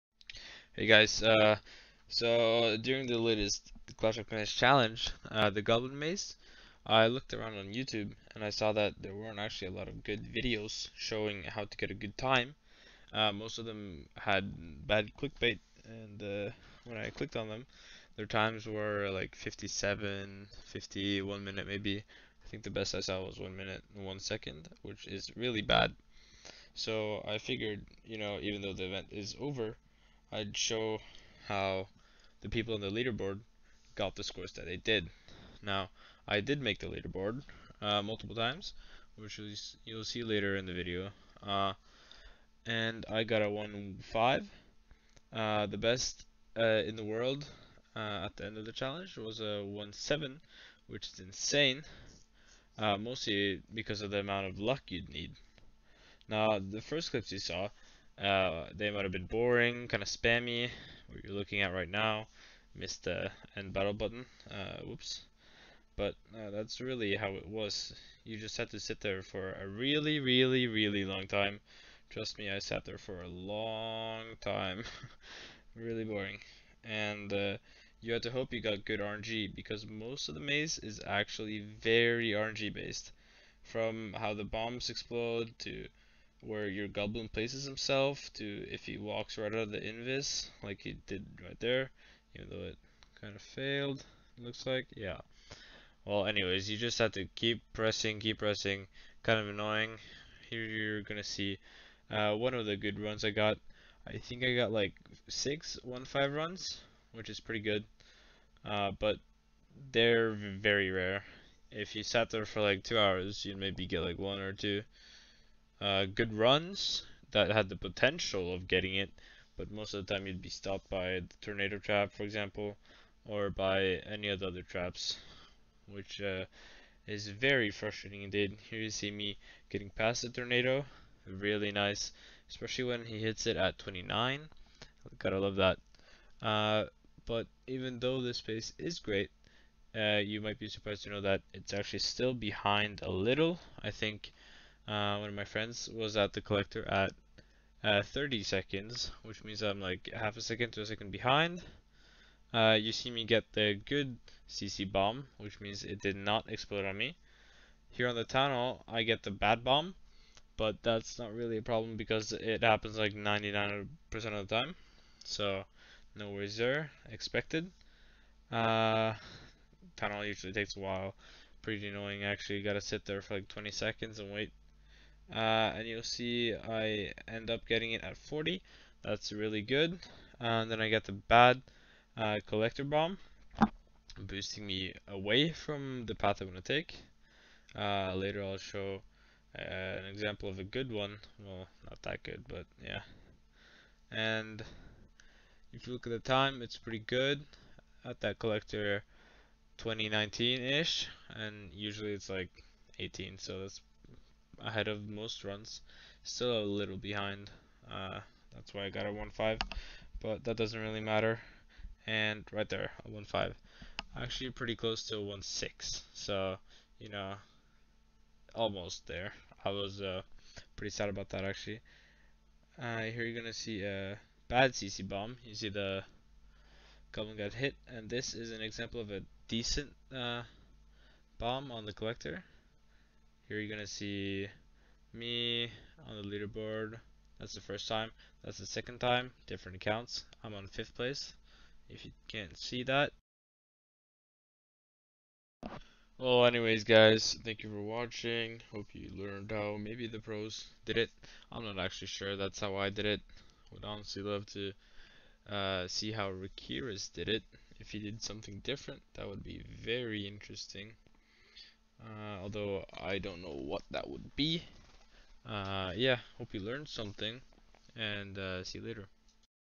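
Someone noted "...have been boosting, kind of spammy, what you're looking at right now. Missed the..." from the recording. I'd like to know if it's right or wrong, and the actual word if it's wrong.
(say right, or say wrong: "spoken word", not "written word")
wrong: "boring", not "boosting".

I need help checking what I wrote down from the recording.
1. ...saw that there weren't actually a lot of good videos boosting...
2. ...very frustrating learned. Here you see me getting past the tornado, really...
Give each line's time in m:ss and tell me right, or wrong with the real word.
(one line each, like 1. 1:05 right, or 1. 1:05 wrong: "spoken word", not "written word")
1. 0:08 wrong: "showing", not "boosting"
2. 2:07 wrong: "indeed", not "learned".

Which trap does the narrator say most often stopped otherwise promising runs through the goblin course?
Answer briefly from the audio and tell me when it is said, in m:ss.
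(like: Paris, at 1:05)
tornado trap, at 2:01.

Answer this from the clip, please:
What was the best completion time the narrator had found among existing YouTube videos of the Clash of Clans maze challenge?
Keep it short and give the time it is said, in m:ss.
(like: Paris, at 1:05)
1 minute and 1 second, at 0:23.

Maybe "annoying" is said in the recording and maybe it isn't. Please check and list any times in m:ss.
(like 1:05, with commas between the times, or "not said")
1:39, 2:51.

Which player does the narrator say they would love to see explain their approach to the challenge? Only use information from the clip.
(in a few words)
Rakiris.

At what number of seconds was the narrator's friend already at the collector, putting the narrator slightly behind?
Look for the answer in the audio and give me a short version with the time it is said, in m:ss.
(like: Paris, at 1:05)
30, at 2:28.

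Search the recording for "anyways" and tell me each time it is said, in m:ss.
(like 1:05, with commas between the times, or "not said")
1:36, 4:06.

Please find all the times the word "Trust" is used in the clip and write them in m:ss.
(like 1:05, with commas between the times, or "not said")
1:12.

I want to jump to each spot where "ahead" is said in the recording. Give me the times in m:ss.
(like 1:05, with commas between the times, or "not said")
3:24.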